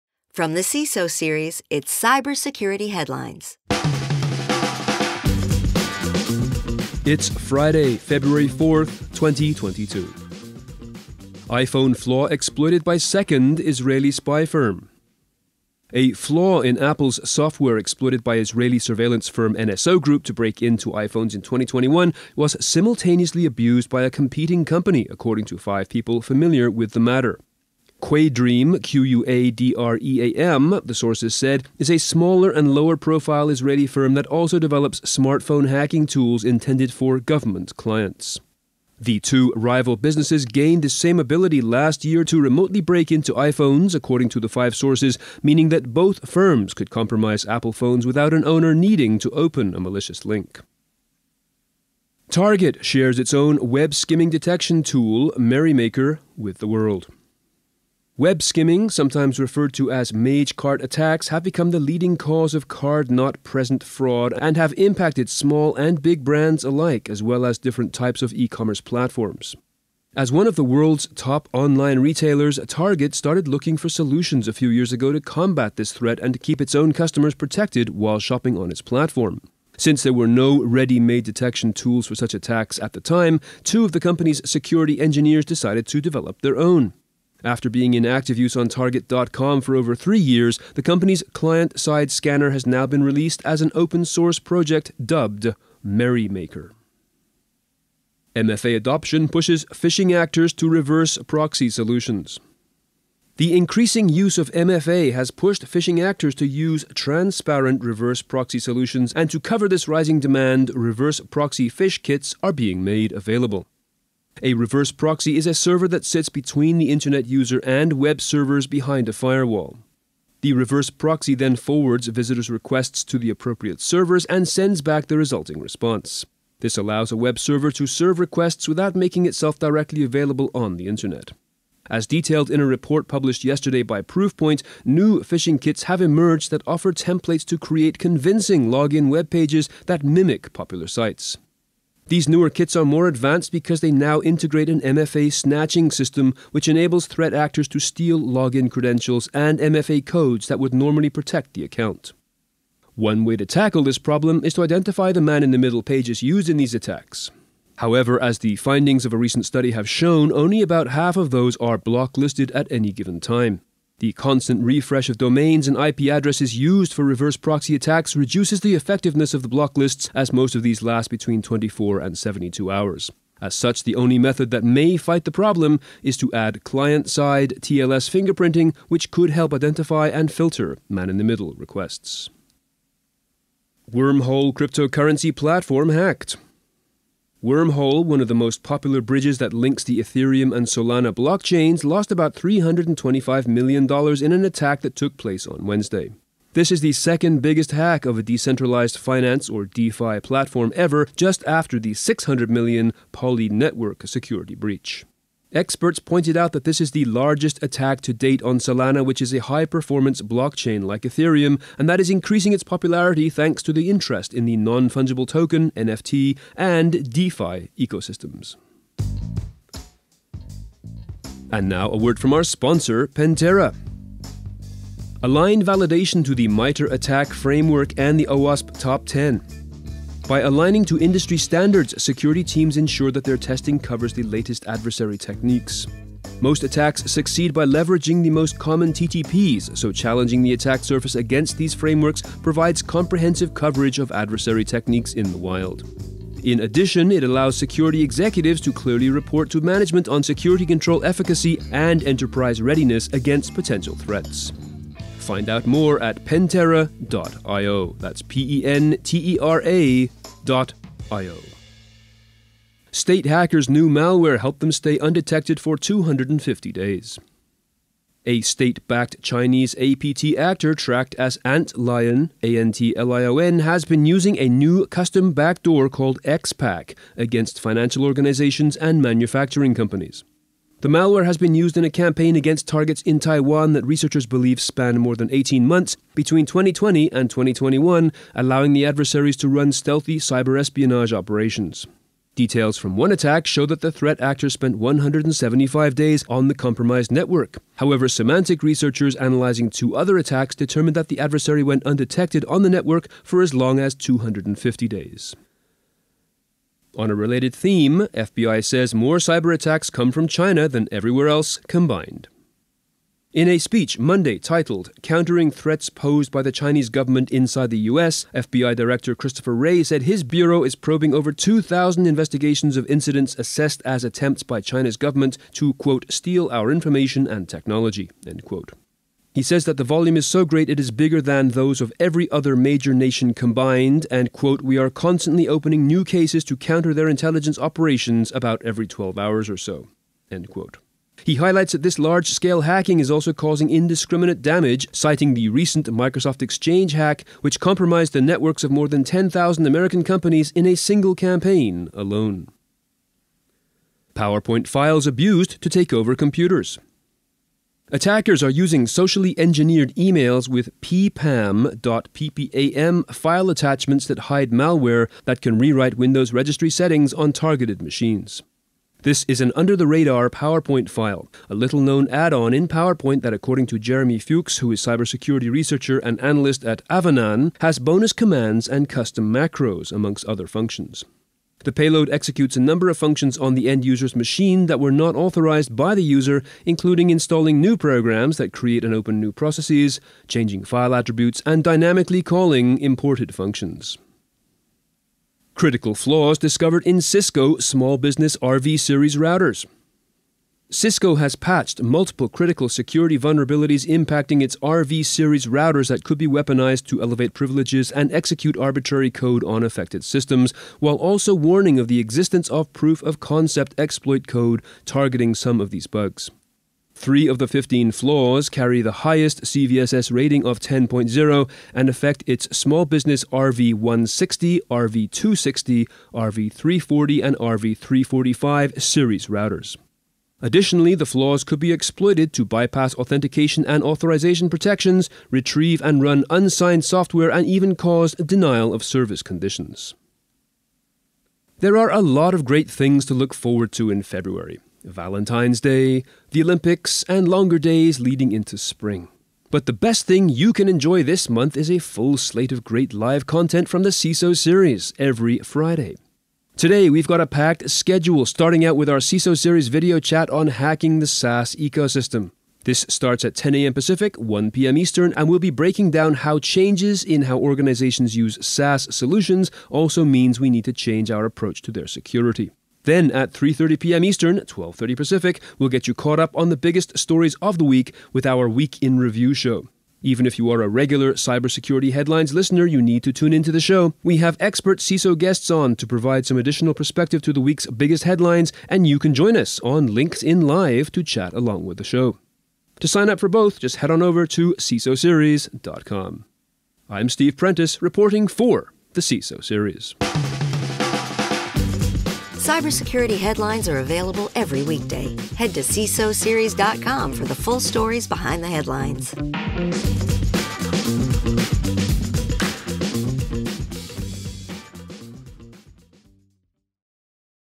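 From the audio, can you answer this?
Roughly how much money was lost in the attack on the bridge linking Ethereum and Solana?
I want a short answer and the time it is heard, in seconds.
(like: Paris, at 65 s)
$325 million, at 192 s.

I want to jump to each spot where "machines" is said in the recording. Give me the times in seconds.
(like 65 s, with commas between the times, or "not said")
367 s, 384 s.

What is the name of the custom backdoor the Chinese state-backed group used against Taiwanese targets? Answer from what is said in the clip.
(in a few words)
xPack.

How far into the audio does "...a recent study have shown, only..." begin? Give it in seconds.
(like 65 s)
159 s.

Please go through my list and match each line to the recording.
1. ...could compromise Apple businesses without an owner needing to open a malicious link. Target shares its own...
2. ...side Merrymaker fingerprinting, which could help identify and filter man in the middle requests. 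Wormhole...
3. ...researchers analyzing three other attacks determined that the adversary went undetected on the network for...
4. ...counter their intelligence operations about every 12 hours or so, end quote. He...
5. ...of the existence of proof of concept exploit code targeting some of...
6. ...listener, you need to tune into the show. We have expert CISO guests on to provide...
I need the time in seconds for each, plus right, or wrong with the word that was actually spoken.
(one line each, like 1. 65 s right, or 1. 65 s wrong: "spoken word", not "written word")
1. 46 s wrong: "phones", not "businesses"
2. 177 s wrong: "TLS", not "Merrymaker"
3. 298 s wrong: "two", not "three"
4. 336 s right
5. 411 s right
6. 482 s right.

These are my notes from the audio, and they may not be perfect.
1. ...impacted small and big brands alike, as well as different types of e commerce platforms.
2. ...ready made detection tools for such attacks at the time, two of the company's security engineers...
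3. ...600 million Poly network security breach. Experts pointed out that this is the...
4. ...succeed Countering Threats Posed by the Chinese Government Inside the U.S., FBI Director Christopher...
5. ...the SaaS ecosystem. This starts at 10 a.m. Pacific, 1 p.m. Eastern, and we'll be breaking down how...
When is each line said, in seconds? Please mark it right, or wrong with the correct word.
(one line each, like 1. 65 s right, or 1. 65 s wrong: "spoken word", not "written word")
1. 64 s right
2. 80 s right
3. 201 s right
4. 314 s wrong: "titled", not "succeed"
5. 460 s right.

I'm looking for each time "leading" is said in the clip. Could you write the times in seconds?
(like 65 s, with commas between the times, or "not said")
61 s, 447 s.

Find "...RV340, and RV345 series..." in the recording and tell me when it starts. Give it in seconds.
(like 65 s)
426 s.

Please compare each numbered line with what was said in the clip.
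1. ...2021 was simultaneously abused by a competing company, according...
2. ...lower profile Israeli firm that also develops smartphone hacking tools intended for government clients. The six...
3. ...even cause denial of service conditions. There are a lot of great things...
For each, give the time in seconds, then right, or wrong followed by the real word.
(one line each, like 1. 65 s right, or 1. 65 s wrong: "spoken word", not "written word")
1. 21 s right
2. 32 s wrong: "two", not "six"
3. 437 s right.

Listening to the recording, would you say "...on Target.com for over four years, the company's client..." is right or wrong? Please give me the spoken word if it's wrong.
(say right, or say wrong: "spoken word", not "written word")
wrong: "three", not "four".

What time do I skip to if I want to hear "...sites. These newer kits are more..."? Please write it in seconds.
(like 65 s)
140 s.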